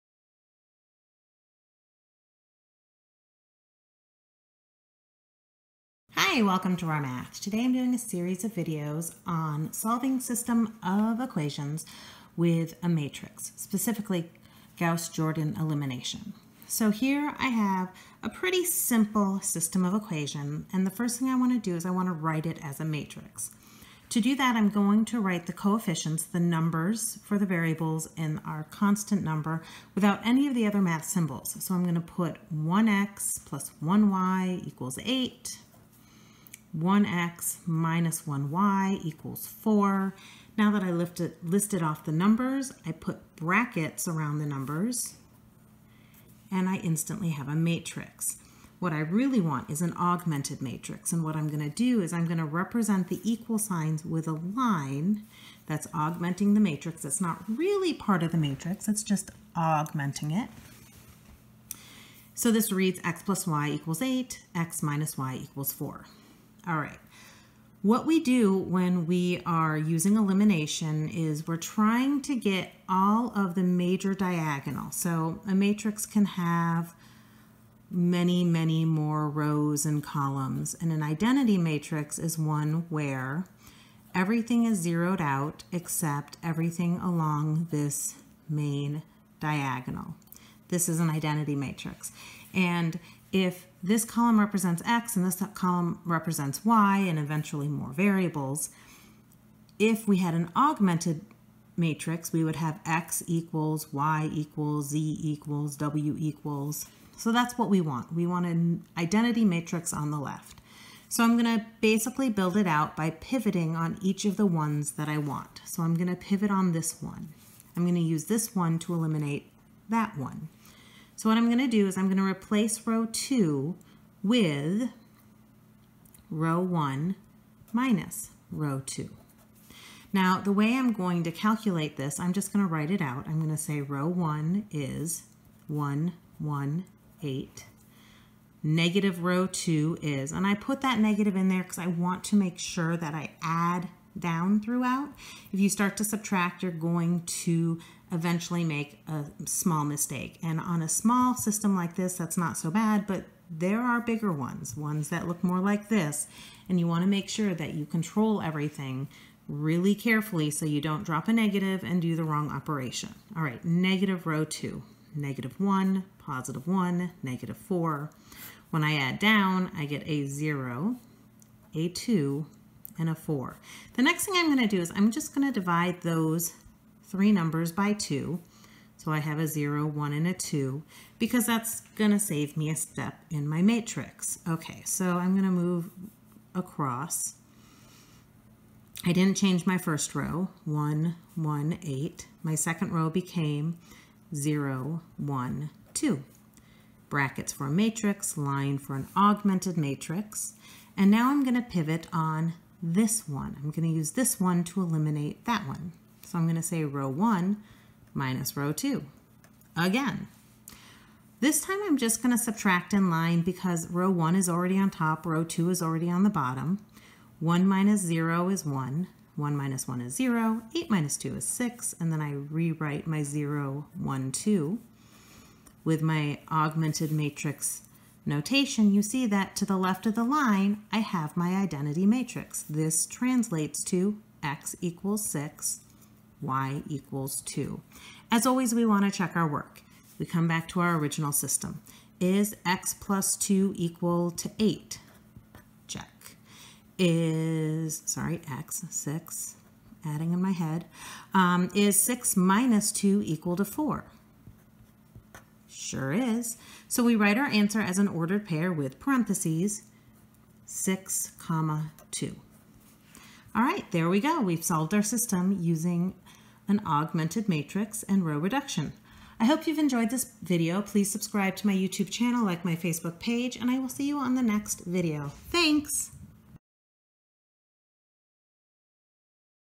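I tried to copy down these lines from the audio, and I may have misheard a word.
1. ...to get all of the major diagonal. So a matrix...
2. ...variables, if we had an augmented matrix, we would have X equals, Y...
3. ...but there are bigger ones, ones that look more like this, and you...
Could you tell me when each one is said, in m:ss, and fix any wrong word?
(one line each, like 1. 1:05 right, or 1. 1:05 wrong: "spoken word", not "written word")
1. 1:12 right
2. 1:37 right
3. 2:33 right.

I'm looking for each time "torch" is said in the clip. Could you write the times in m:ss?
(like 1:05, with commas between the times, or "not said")
not said.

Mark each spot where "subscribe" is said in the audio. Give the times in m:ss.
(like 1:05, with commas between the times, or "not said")
4:31.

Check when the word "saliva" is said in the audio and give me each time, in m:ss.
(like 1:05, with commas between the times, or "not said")
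not said.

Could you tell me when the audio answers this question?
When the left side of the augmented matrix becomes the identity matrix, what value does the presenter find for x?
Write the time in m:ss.
3:54.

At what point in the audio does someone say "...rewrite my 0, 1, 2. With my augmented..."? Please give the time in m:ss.
3:42.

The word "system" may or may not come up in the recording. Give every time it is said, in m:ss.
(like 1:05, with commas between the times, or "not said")
0:10, 0:19, 2:31, 4:01, 4:25.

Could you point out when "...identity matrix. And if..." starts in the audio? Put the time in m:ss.
1:31.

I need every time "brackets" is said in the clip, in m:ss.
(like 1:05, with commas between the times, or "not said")
0:43, 3:17.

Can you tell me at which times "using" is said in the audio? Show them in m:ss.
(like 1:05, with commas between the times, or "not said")
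1:09, 4:25.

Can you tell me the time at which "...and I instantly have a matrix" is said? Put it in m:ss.
0:46.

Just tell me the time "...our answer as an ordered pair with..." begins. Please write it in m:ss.
4:17.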